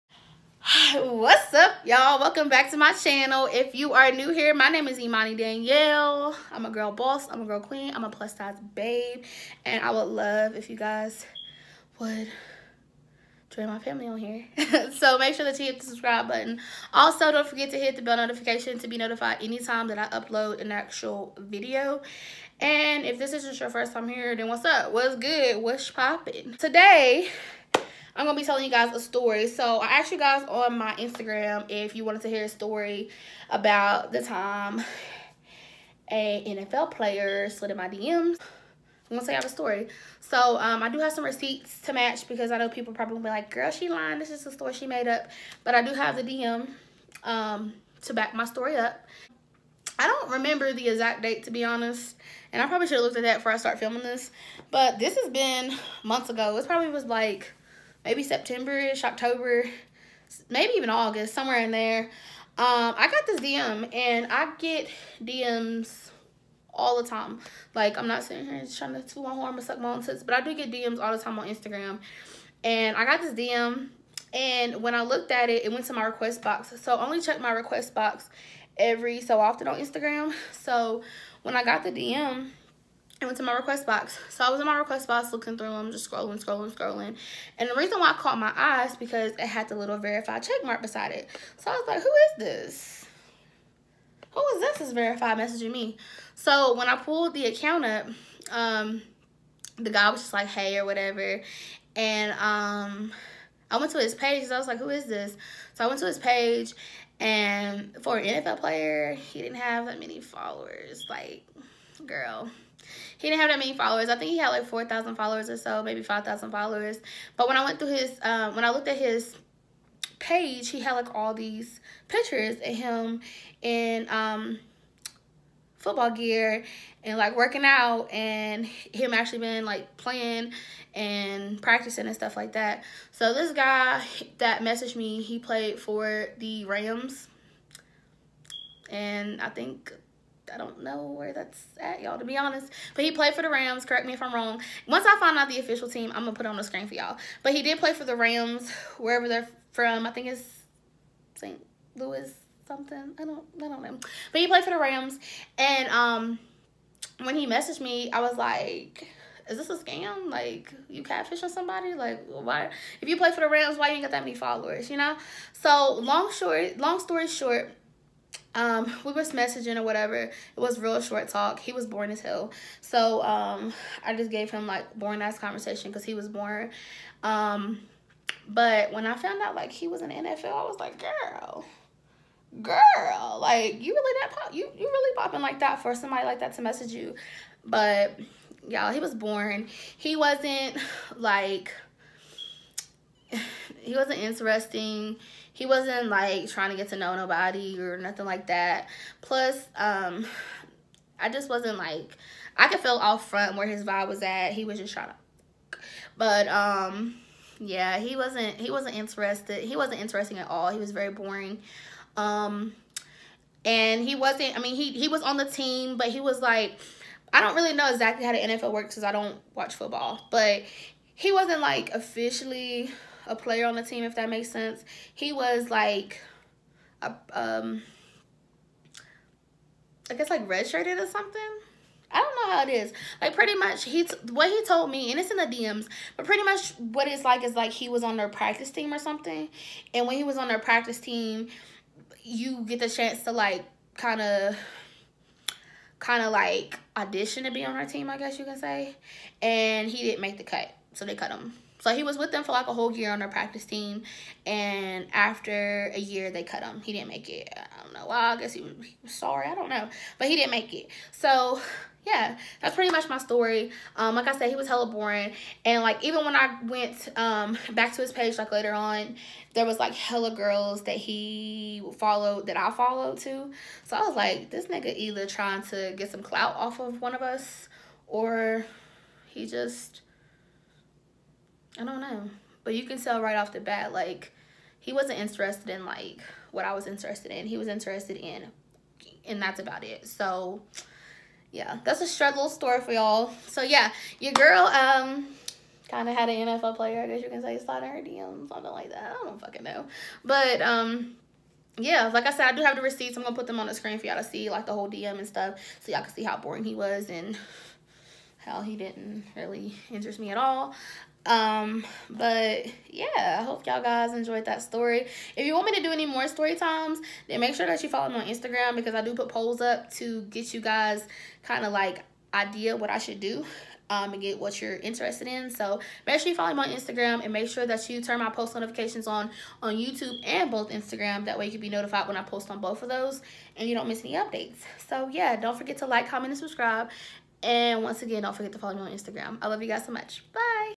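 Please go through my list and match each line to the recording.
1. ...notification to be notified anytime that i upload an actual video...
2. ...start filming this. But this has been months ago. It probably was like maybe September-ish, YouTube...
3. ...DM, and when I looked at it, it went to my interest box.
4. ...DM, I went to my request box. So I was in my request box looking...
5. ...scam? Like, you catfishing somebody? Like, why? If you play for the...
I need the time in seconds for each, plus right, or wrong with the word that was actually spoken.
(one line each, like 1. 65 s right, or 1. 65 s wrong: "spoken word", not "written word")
1. 18 s right
2. 53 s wrong: "October", not "YouTube"
3. 73 s wrong: "request", not "interest"
4. 81 s right
5. 159 s right.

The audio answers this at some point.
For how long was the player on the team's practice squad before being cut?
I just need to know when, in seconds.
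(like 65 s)
252 s.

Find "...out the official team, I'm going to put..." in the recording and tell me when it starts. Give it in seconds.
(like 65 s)
145 s.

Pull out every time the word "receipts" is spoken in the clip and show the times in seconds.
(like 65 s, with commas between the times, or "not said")
41 s, 302 s.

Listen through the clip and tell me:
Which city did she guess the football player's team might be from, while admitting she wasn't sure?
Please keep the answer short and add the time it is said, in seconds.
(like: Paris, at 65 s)
St. Louis, at 151 s.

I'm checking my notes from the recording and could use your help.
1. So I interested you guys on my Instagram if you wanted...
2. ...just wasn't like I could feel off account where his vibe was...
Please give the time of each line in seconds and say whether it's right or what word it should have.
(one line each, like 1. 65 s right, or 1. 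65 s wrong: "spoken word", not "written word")
1. 29 s wrong: "asked", not "interested"
2. 201 s wrong: "front", not "account".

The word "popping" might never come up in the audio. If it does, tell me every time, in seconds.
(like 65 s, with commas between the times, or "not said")
25 s, 185 s.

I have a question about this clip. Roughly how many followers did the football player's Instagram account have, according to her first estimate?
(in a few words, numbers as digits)
4,000.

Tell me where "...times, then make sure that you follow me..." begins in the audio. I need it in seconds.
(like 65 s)
316 s.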